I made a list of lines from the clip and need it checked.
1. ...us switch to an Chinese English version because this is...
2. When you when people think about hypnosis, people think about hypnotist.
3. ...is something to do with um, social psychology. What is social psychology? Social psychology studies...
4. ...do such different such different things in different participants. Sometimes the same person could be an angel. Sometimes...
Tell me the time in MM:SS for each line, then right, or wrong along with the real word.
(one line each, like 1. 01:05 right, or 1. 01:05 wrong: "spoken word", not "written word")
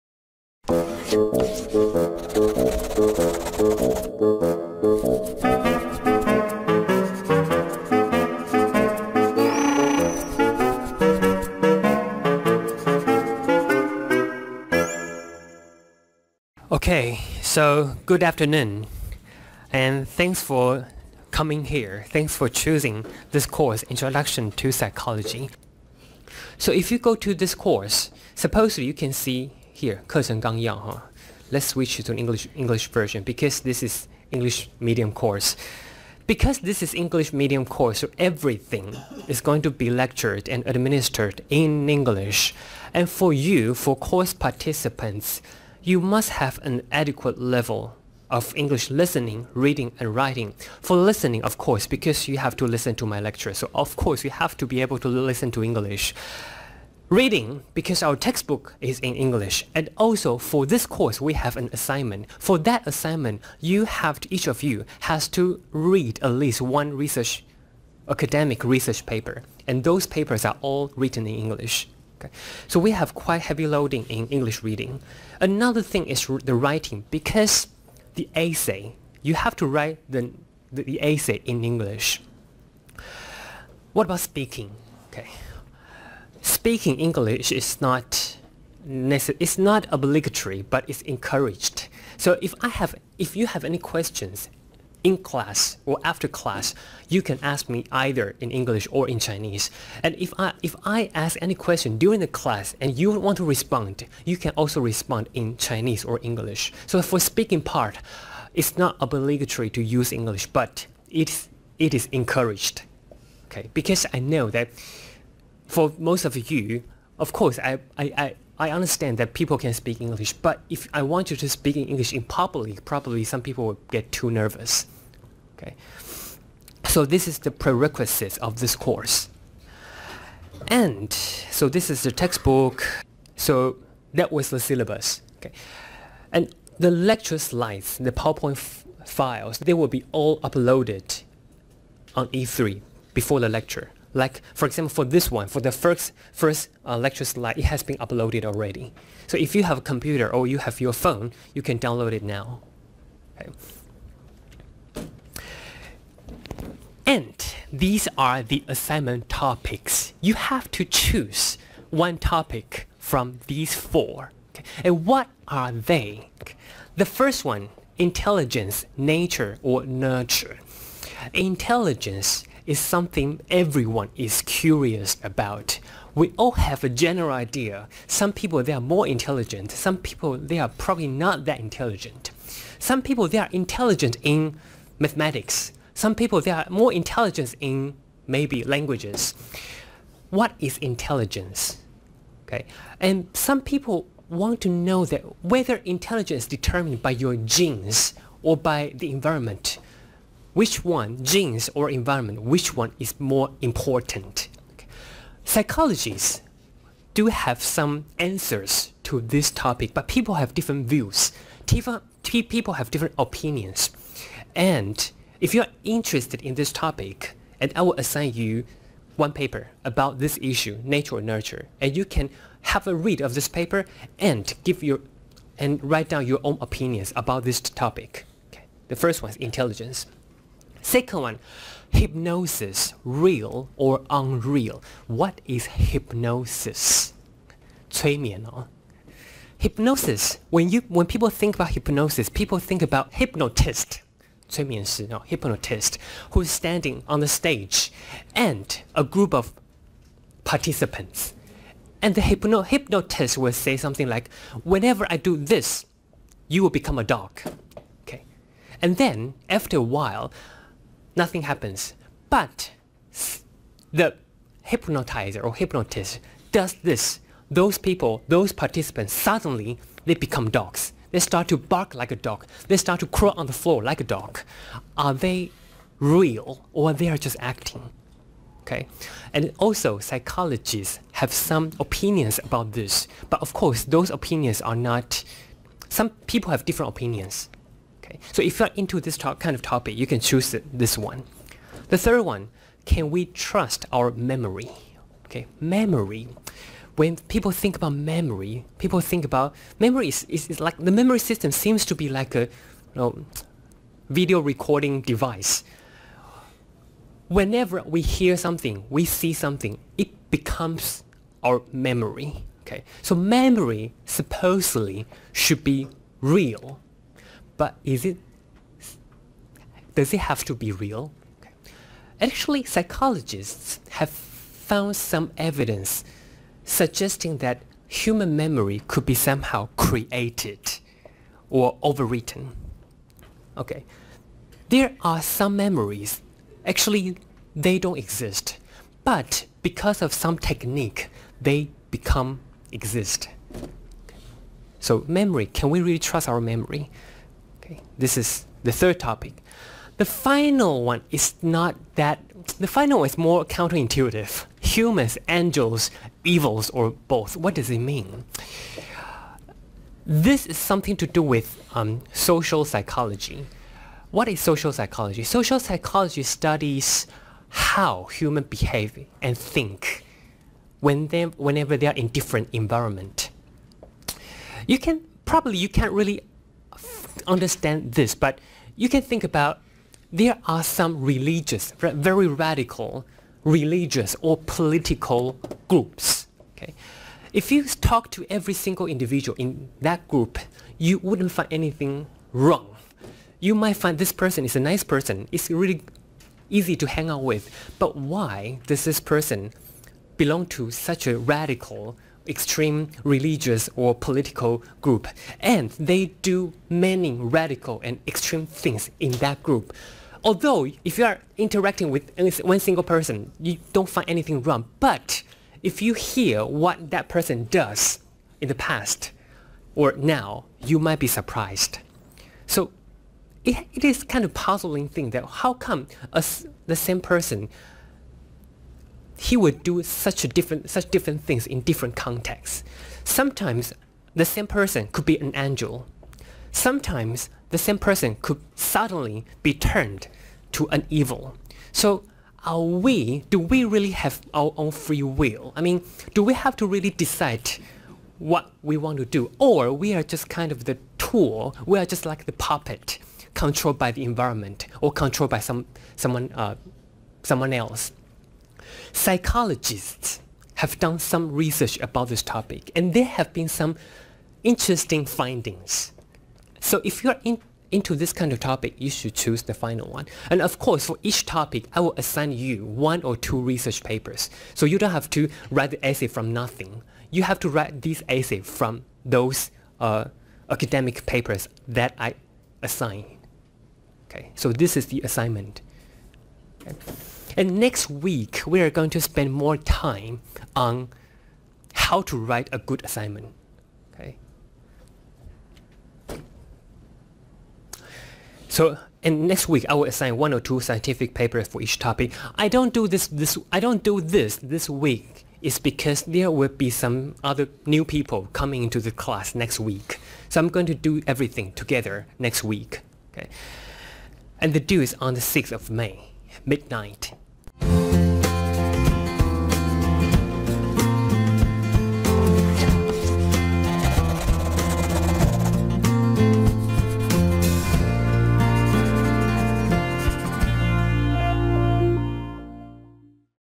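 1. 00:31 wrong: "English", not "Chinese"
2. 04:00 right
3. 06:00 right
4. 07:09 wrong: "contexts", not "participants".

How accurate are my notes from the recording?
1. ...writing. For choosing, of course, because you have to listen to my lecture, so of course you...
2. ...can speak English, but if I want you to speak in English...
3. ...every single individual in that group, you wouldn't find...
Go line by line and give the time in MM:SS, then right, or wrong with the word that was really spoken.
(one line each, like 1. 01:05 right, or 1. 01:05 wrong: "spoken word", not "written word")
1. 00:50 wrong: "listening", not "choosing"
2. 01:59 right
3. 06:28 right.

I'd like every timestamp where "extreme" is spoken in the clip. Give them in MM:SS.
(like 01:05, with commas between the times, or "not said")
06:42, 06:48.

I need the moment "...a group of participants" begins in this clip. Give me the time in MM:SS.
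04:08.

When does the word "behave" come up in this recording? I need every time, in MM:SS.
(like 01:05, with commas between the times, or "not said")
06:08.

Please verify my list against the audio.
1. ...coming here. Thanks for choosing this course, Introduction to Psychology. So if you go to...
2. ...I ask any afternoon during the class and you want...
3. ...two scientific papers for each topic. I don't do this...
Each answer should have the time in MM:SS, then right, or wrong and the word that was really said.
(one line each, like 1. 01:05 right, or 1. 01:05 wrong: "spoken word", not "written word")
1. 00:21 right
2. 01:40 wrong: "question", not "afternoon"
3. 08:20 right.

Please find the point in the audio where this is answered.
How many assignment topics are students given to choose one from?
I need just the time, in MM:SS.
02:43.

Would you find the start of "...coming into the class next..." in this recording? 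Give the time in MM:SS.
08:28.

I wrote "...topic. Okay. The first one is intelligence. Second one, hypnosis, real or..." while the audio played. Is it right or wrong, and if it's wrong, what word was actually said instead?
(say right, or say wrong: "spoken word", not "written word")
right.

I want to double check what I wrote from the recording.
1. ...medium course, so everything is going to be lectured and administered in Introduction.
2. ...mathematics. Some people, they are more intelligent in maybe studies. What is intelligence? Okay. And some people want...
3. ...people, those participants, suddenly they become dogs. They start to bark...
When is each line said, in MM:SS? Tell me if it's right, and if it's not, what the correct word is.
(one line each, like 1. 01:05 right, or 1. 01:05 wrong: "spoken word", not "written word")
1. 00:37 wrong: "English", not "Introduction"
2. 03:04 wrong: "languages", not "studies"
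3. 04:27 right.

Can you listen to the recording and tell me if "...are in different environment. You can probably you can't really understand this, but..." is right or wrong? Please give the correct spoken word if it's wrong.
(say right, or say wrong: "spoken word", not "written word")
right.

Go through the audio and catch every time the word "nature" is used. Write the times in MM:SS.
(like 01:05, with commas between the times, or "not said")
02:48, 03:40.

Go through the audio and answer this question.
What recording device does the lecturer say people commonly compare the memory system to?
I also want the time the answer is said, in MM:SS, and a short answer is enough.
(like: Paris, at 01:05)
Video recording device, at 05:04.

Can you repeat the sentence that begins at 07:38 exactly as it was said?
Psychologists have done some research about this topic and there have been some interesting findings.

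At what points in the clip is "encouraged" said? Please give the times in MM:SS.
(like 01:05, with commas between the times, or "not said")
01:31, 01:52.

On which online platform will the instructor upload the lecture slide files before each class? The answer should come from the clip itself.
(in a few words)
E3.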